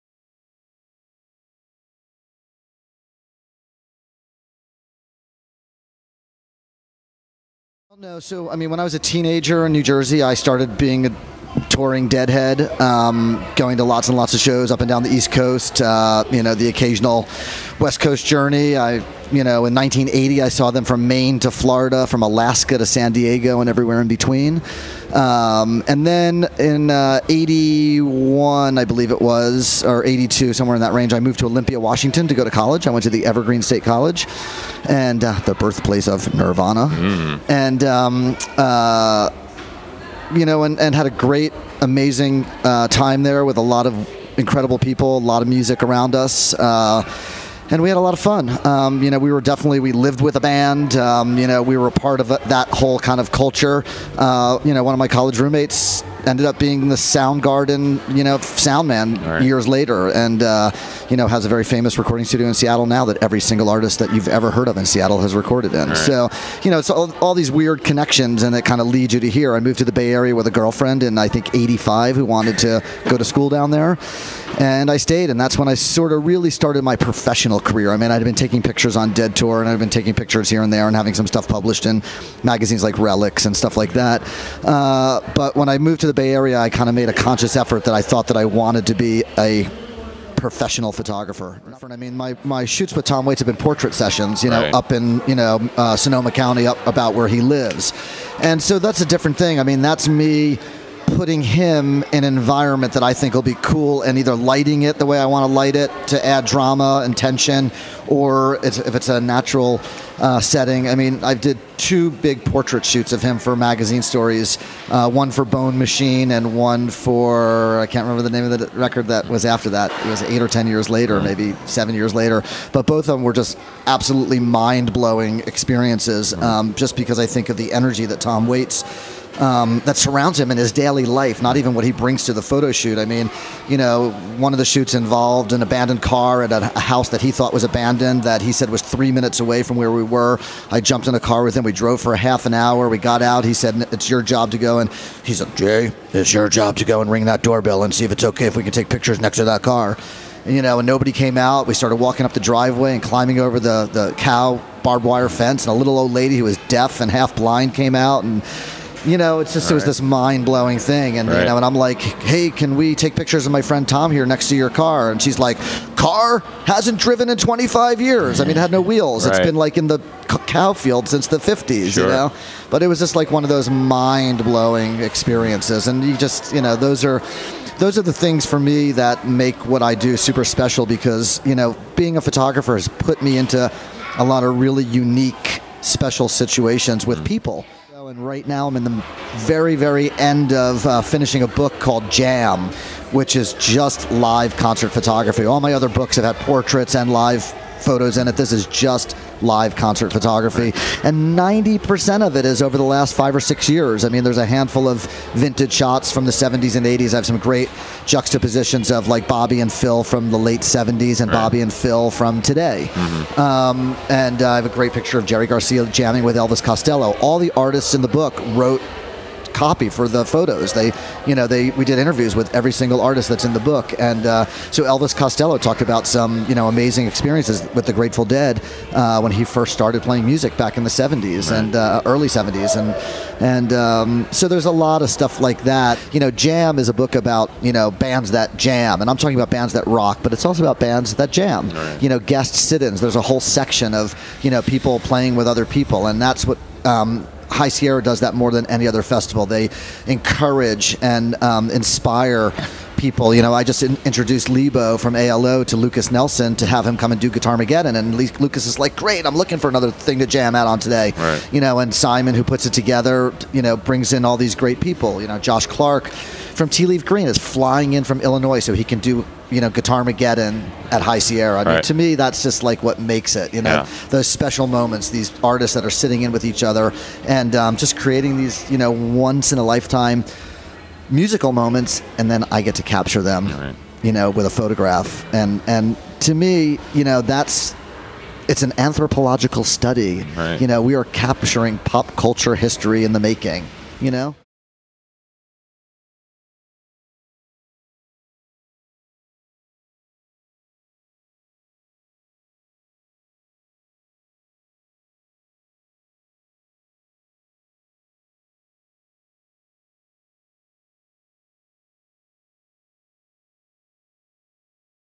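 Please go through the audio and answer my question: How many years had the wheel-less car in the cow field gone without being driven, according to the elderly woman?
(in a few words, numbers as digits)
25.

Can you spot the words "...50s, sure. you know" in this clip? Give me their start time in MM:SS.
02:51.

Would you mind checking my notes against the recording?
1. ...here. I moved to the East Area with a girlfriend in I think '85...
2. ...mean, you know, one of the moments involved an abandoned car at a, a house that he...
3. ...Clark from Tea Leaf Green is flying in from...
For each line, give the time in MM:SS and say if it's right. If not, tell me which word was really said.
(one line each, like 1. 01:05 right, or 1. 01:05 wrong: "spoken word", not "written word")
1. 01:09 wrong: "Bay", not "East"
2. 02:13 wrong: "shoots", not "moments"
3. 04:25 right.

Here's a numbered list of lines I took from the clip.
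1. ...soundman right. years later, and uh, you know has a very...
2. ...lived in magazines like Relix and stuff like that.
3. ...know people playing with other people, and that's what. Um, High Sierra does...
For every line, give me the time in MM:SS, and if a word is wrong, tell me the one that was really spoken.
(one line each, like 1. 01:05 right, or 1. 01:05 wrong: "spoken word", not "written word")
1. 00:58 right
2. 01:21 wrong: "published", not "lived"
3. 04:04 right.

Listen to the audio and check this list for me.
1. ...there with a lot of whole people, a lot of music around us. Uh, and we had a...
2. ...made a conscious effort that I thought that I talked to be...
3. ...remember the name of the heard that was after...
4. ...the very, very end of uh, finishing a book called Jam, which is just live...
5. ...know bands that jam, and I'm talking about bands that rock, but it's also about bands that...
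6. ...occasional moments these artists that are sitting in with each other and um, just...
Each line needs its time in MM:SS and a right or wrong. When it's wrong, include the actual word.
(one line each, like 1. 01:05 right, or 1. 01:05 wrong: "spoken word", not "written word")
1. 00:43 wrong: "incredible", not "whole"
2. 01:26 wrong: "wanted", not "talked"
3. 01:58 wrong: "record", not "heard"
4. 03:08 right
5. 03:57 right
6. 04:34 wrong: "special", not "occasional".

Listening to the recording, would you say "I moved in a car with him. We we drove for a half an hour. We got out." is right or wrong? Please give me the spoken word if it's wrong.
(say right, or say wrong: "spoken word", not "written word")
wrong: "jumped", not "moved".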